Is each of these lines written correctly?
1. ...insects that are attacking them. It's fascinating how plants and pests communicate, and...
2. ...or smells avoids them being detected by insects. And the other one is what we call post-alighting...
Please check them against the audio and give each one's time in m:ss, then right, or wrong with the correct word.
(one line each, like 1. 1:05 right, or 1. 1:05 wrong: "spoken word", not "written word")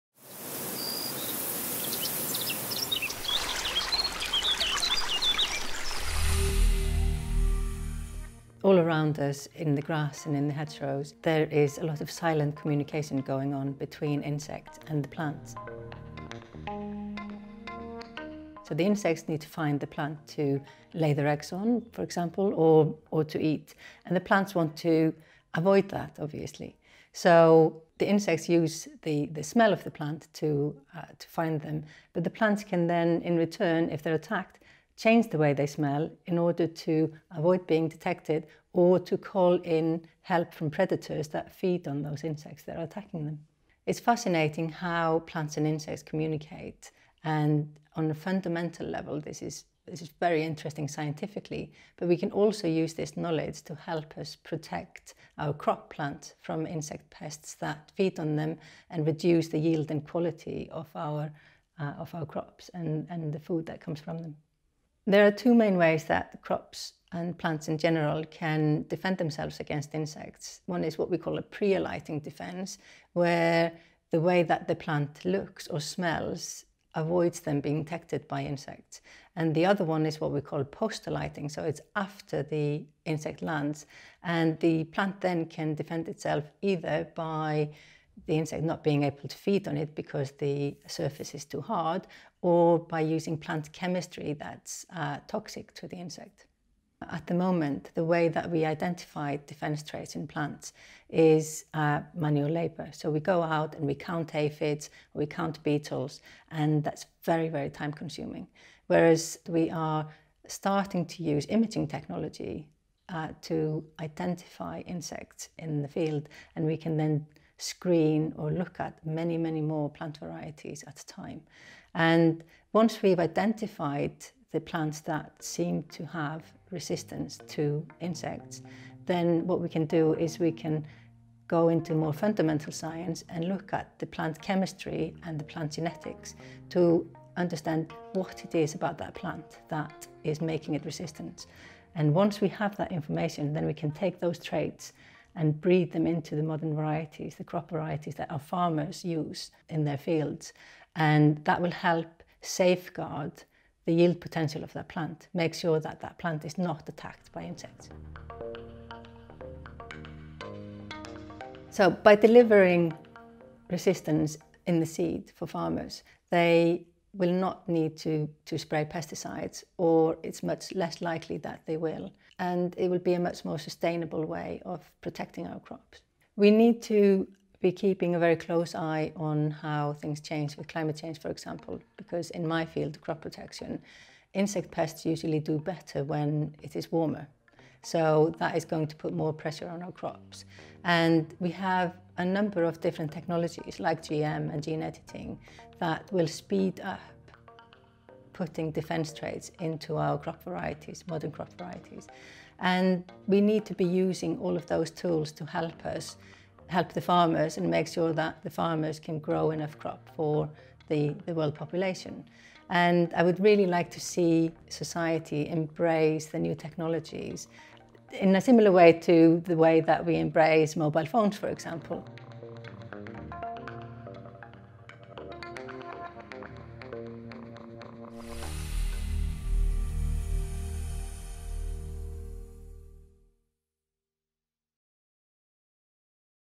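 1. 0:42 wrong: "insects", not "pests"
2. 1:15 right.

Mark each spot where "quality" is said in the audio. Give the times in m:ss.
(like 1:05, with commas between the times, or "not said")
1:00.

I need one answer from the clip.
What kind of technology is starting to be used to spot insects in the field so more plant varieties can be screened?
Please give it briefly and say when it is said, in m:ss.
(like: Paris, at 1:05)
imaging technology, at 1:51.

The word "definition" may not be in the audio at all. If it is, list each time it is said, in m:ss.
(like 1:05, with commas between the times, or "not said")
not said.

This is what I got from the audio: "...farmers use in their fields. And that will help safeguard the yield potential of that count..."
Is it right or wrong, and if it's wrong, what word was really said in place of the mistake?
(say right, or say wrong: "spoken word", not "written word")
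wrong: "plant", not "count".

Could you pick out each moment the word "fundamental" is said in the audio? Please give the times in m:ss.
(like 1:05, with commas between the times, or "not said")
0:48, 2:12.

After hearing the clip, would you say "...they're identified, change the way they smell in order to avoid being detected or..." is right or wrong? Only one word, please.
wrong.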